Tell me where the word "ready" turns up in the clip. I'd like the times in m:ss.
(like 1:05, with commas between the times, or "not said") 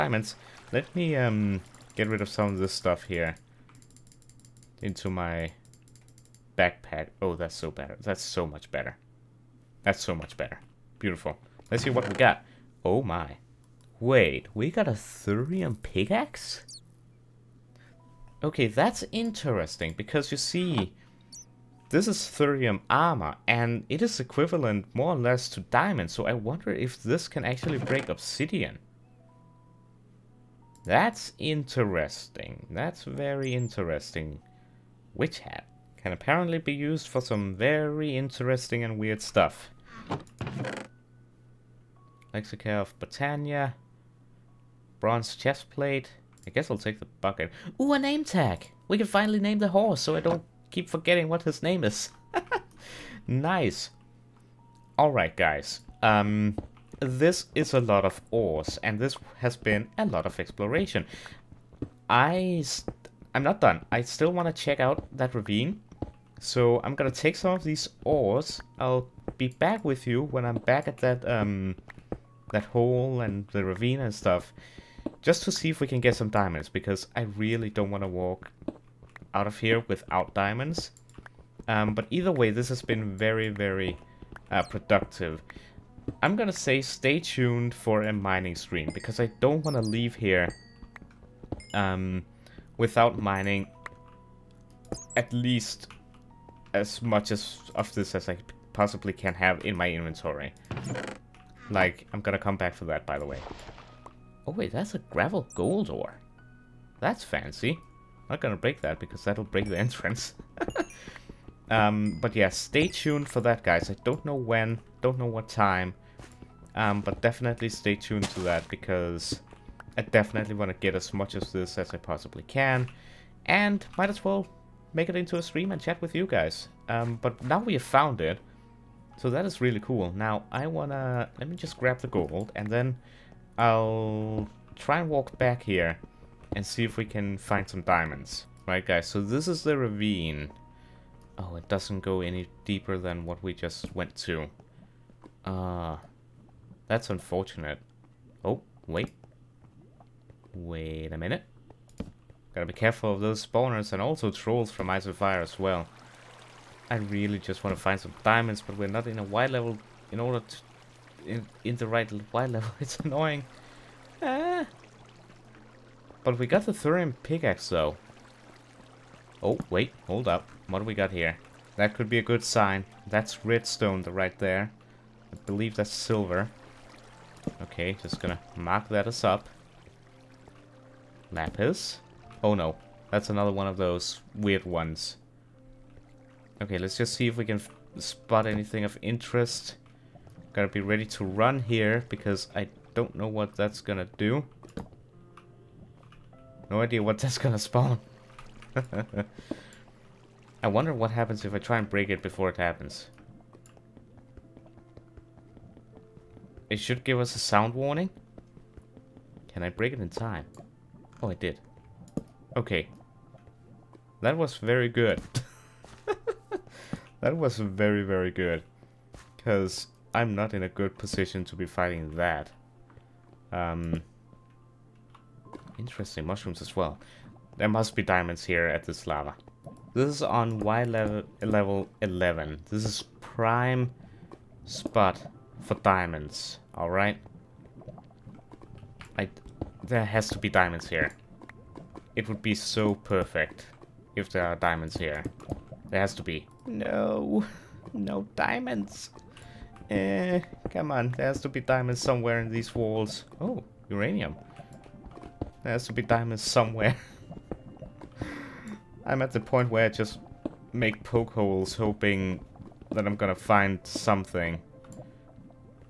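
3:10.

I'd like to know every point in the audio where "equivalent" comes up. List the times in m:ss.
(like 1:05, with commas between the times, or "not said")
0:24.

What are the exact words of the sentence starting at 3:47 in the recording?
There must be diamonds here at this lava.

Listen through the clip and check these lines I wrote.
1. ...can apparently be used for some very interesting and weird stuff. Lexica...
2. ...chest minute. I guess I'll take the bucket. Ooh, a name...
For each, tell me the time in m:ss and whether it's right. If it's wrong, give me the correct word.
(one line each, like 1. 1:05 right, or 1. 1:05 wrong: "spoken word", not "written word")
1. 0:36 right
2. 0:45 wrong: "plate", not "minute".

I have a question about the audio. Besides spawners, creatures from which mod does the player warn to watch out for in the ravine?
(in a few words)
Ice and Fire.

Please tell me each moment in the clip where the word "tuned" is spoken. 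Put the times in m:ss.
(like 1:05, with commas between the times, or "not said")
1:27, 1:52, 1:57.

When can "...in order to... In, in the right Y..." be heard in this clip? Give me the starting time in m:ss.
2:40.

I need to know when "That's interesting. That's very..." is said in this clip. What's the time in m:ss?
0:30.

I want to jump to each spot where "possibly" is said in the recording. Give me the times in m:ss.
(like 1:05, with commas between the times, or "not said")
1:38, 2:01.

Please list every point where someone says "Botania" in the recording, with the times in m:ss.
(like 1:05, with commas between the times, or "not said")
0:42.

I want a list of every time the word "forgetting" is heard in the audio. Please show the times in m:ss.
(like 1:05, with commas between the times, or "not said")
0:50.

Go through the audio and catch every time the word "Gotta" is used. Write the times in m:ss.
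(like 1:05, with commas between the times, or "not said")
2:32, 3:10.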